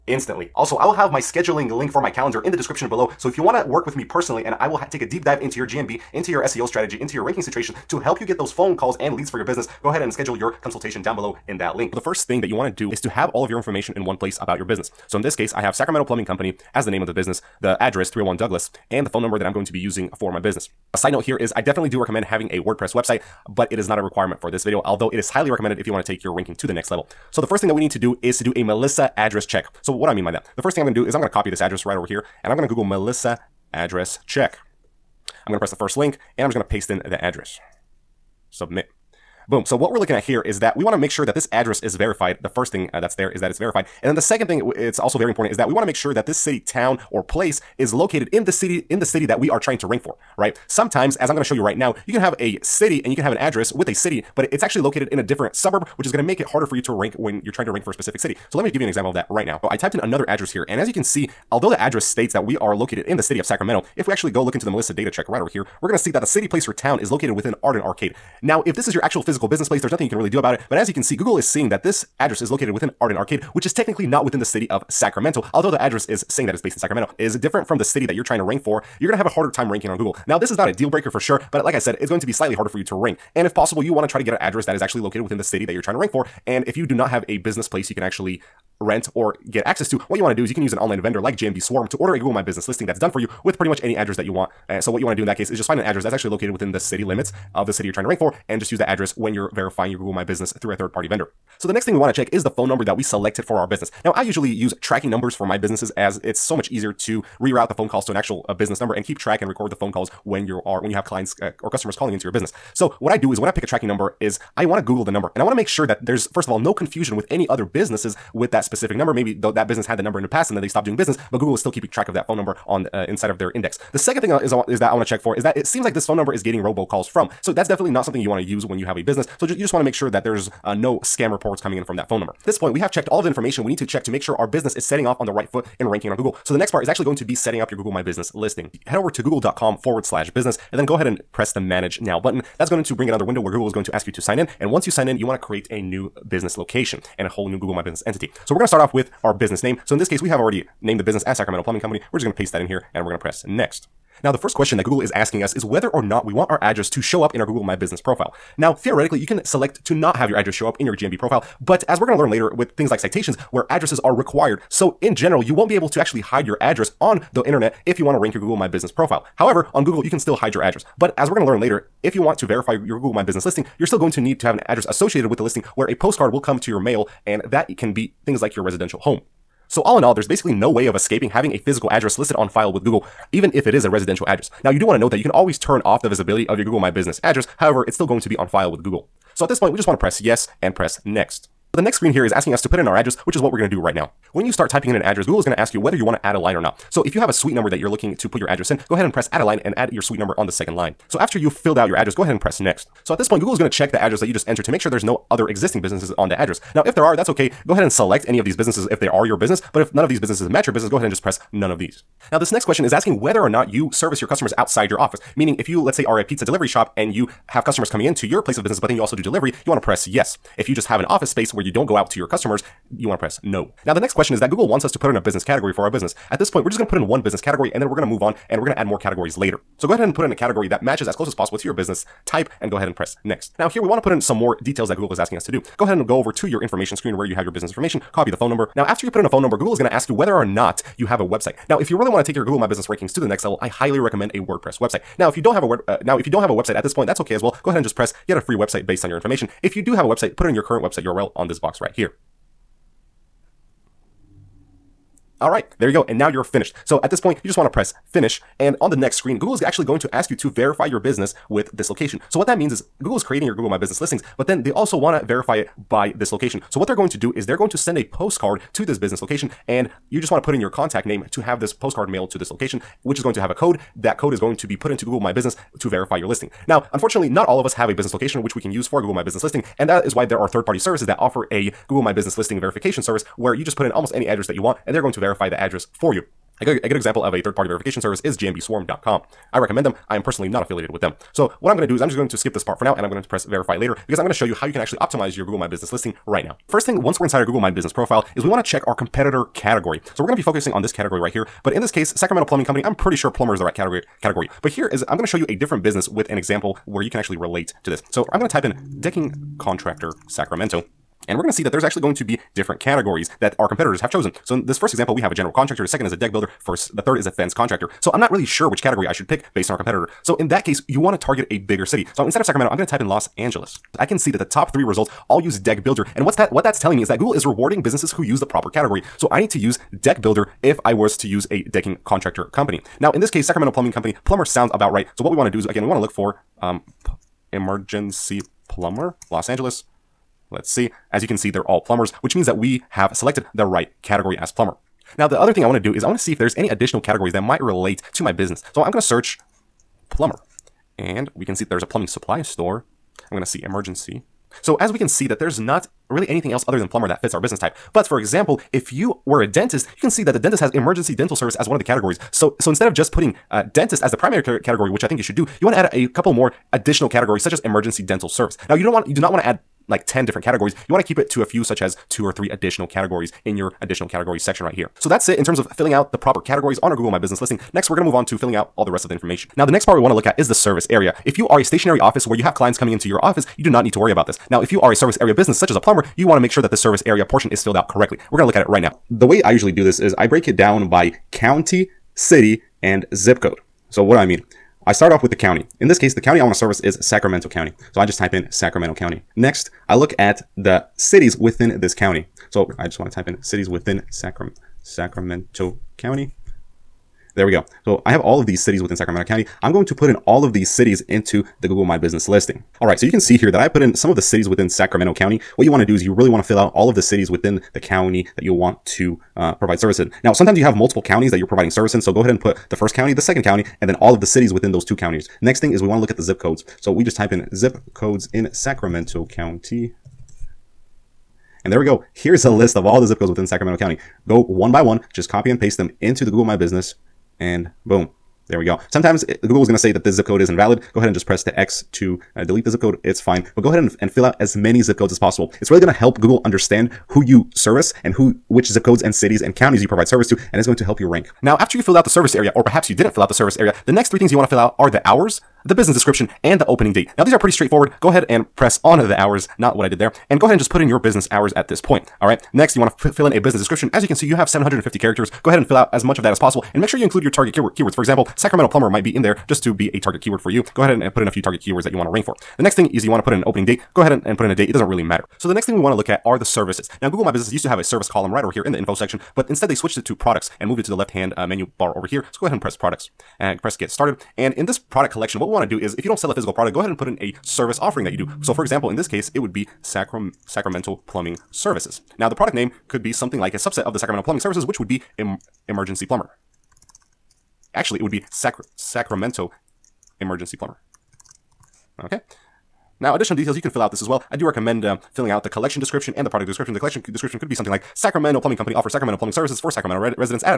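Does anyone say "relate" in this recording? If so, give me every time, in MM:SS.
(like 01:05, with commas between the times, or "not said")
05:07, 05:47.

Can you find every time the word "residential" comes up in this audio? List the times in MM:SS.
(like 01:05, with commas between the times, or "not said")
02:58, 03:03.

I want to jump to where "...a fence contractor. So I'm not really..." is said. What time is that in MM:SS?
05:17.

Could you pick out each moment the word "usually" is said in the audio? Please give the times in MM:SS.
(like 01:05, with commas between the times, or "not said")
01:44, 06:29.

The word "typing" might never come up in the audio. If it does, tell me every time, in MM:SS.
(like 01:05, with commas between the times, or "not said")
03:14.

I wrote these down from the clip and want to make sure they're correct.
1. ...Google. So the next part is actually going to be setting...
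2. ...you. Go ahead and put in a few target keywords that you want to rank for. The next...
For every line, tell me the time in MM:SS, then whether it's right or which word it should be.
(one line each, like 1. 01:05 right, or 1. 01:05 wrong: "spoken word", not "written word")
1. 02:16 right
2. 07:50 right.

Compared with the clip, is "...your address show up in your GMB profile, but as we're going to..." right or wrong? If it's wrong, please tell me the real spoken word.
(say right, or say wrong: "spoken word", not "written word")
right.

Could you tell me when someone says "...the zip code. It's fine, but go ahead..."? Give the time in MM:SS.
07:22.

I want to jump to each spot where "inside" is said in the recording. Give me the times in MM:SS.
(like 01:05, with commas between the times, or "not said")
02:03, 04:57.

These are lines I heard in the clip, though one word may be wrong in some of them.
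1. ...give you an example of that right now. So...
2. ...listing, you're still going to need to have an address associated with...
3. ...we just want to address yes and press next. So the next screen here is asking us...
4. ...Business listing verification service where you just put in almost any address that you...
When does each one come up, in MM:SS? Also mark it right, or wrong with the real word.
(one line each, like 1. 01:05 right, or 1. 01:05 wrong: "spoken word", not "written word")
1. 00:58 right
2. 02:53 right
3. 03:09 wrong: "press", not "address"
4. 04:42 right.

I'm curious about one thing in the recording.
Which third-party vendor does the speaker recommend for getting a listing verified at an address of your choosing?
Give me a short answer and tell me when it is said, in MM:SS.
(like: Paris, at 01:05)
GMB Swarm, at 01:31.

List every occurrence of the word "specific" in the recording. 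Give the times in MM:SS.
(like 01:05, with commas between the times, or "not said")
00:57, 01:58.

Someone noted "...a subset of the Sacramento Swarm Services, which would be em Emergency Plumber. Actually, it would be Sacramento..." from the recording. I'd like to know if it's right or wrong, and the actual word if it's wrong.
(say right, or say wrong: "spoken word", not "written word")
wrong: "Plumbing", not "Swarm".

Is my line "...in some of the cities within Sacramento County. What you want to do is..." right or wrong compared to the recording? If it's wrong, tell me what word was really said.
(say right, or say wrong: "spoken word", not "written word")
right.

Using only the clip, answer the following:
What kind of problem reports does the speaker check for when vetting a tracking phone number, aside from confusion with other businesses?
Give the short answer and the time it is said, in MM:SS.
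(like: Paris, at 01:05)
robocalls, at 02:06.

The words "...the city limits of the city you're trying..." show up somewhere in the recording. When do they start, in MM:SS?
01:36.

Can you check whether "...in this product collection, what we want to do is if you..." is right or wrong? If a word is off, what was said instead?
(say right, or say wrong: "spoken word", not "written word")
right.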